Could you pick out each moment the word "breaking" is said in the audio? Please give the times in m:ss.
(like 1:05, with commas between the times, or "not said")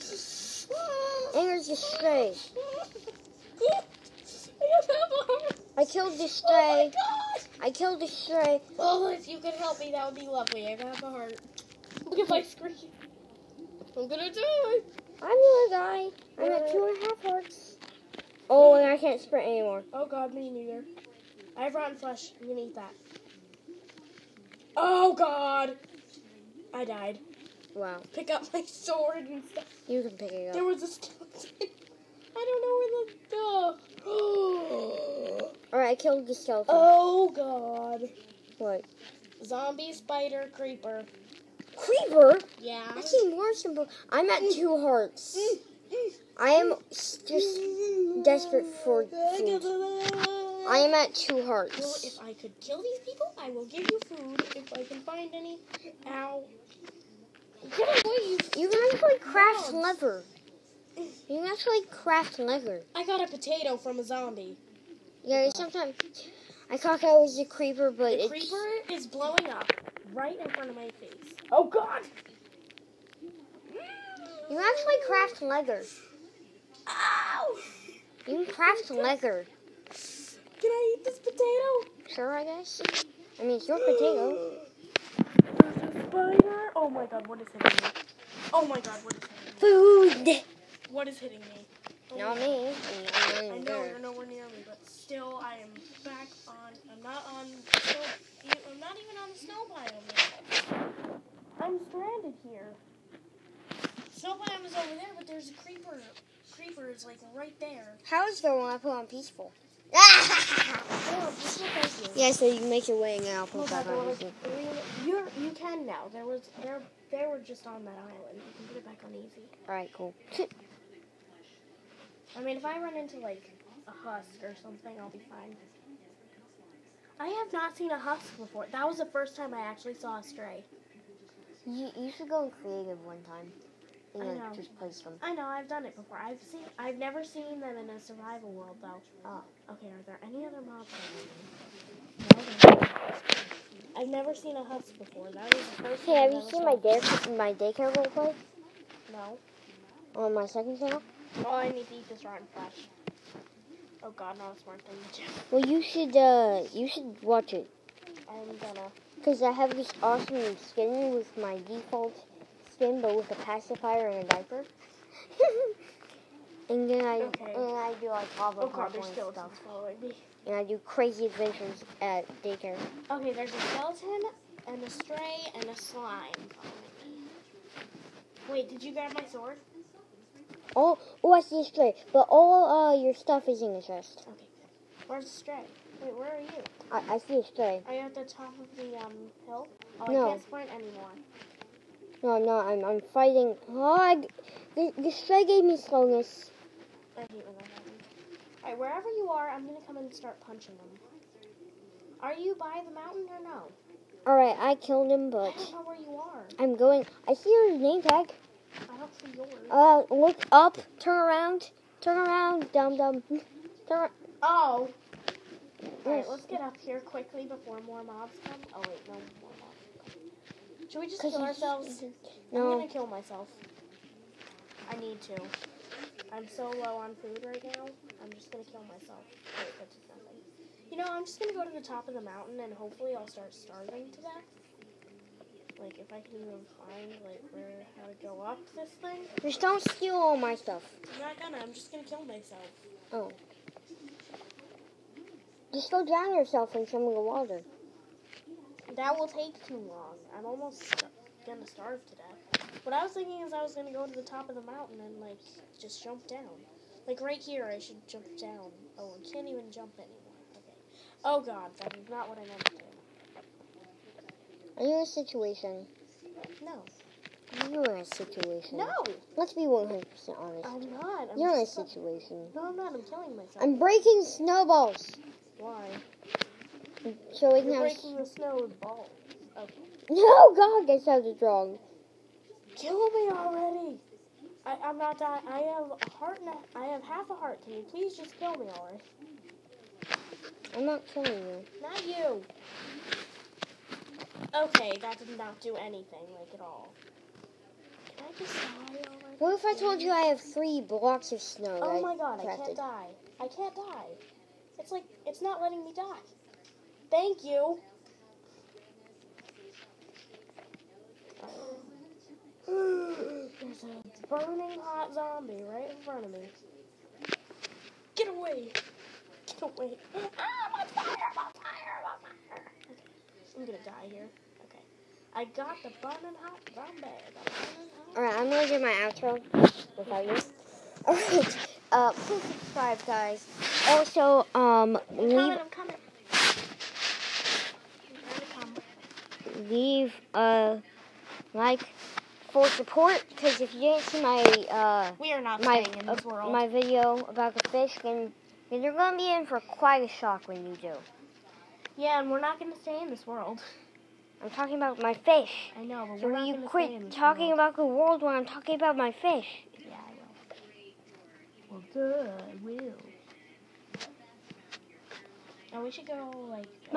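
4:33, 4:37.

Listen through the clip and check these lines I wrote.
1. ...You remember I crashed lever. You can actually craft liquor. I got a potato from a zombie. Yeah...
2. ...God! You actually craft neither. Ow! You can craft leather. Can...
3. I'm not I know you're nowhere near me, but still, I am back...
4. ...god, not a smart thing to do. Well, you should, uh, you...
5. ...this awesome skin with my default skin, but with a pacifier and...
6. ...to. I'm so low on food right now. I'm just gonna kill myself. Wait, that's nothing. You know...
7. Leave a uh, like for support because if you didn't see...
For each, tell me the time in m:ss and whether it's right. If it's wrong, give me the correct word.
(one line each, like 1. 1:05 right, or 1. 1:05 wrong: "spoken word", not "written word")
1. 0:58 right
2. 1:11 wrong: "leather", not "neither"
3. 1:33 right
4. 2:34 right
5. 2:39 right
6. 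3:45 right
7. 5:39 right.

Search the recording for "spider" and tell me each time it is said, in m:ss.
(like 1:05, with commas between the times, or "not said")
0:39, 1:26.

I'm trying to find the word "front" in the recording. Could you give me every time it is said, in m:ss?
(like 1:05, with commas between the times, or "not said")
1:10, 5:16.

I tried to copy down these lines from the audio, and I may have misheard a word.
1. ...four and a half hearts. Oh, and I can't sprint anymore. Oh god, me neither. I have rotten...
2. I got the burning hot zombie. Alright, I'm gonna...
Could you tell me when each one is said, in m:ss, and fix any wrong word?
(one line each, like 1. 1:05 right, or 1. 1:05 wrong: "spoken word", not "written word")
1. 0:16 wrong: "two", not "four"
2. 5:25 right.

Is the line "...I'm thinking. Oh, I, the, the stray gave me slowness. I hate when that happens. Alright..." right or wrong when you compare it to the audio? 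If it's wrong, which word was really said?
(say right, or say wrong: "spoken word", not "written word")
wrong: "fighting", not "thinking".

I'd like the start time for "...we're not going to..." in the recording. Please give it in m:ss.
5:52.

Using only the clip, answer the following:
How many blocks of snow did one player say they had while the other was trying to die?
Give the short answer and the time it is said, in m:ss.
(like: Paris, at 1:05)
3, at 5:00.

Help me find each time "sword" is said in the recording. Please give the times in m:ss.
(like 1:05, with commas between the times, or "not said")
0:28, 2:59.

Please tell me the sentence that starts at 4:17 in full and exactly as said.
Like, right here, I should jump down.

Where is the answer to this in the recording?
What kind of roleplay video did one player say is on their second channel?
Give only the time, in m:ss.
2:27.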